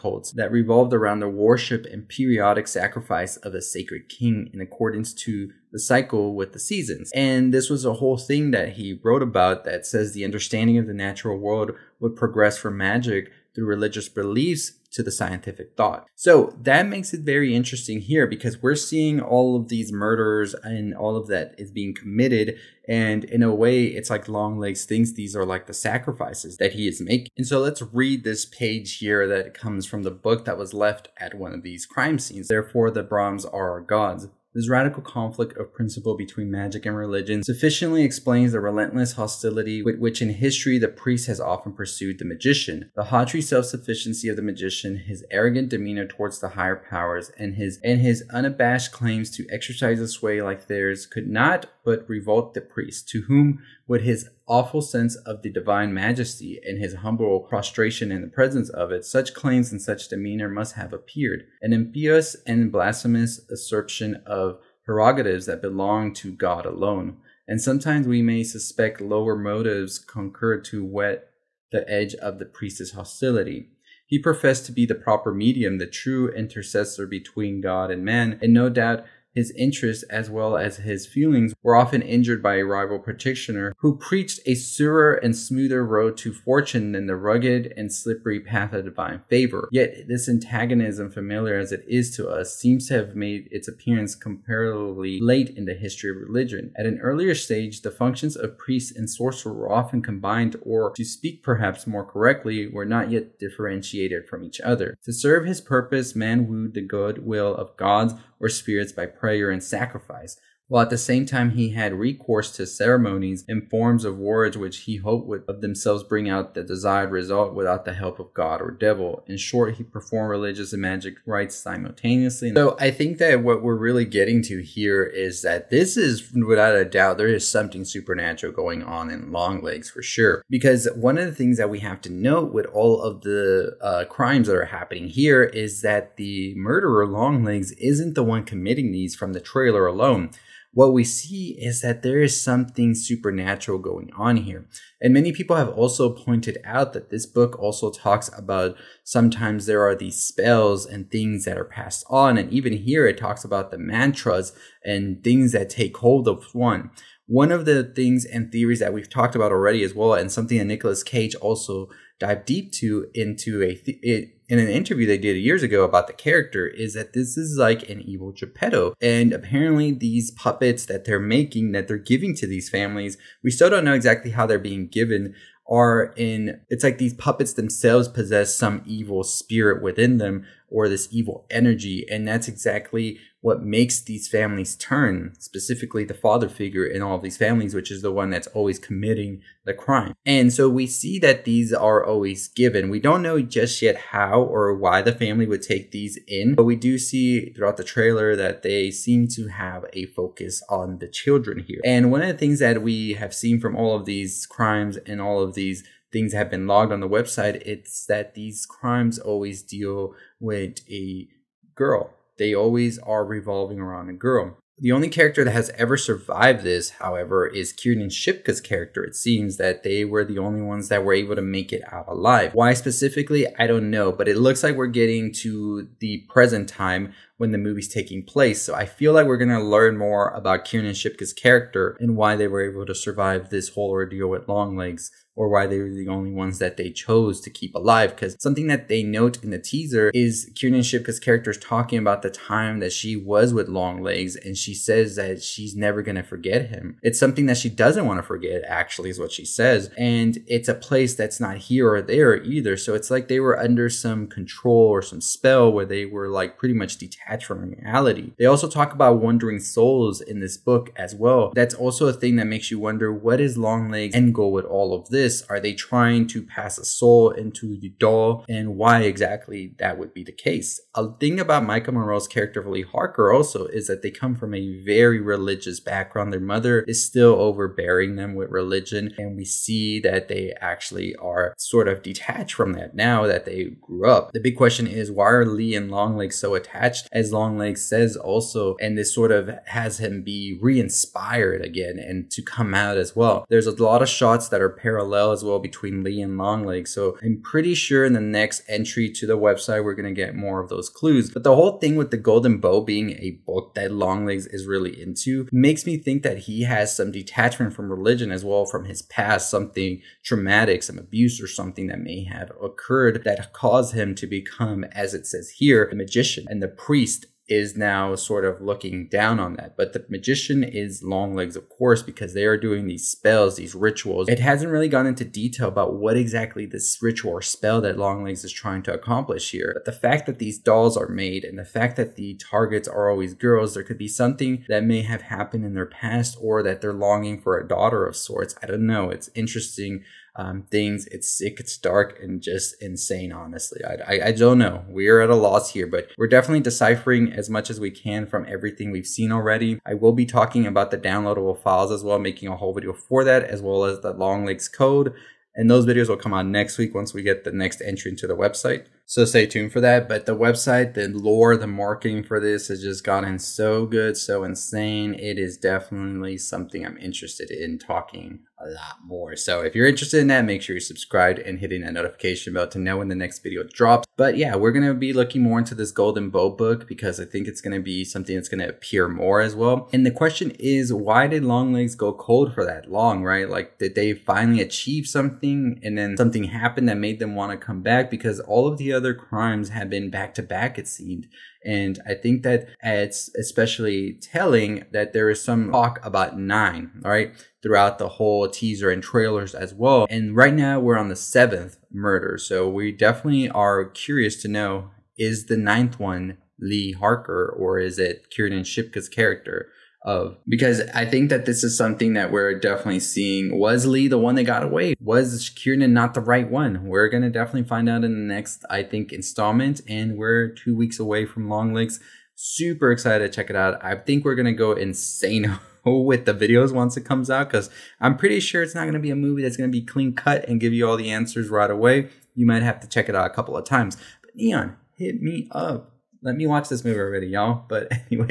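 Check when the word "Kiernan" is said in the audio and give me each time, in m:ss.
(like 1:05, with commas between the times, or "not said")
3:37, 3:50, 4:00, 6:48, 6:55.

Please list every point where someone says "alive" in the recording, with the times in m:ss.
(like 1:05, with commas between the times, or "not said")
3:42, 3:57.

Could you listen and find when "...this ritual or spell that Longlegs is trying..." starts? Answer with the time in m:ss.
5:26.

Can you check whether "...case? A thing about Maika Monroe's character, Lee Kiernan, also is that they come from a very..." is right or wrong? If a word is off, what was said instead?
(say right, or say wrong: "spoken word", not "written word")
wrong: "Harker", not "Kiernan".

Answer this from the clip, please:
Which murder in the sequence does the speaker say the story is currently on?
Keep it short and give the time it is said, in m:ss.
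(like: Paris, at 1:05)
The seventh, at 6:41.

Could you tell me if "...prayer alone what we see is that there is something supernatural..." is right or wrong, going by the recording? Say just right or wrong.
wrong.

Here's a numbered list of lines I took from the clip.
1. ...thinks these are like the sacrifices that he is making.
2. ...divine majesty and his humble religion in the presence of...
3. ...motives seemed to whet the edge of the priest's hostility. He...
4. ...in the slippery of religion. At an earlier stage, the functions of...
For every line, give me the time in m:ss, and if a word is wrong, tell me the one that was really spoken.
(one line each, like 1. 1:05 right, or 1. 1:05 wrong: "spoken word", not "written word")
1. 0:24 right
2. 0:55 wrong: "prostration", not "religion"
3. 1:09 wrong: "concurred", not "seemed"
4. 1:35 wrong: "history", not "slippery".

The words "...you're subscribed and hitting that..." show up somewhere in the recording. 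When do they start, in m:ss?
6:10.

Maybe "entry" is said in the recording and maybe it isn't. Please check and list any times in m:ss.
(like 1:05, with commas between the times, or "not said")
4:58, 5:57.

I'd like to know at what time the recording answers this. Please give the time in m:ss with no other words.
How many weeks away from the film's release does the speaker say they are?
7:00.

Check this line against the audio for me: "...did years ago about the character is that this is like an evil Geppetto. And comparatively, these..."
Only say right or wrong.
wrong.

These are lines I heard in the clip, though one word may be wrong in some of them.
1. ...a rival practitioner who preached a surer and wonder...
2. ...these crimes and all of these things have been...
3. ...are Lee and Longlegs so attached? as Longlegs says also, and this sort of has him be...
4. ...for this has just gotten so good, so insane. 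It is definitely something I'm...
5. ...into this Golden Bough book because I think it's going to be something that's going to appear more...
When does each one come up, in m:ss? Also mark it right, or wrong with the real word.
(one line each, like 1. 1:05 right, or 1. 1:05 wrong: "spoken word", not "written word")
1. 1:22 wrong: "smoother", not "wonder"
2. 3:24 right
3. 4:45 right
4. 6:02 right
5. 6:15 right.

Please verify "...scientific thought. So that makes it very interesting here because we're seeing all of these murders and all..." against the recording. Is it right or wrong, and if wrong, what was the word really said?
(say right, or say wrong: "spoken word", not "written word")
right.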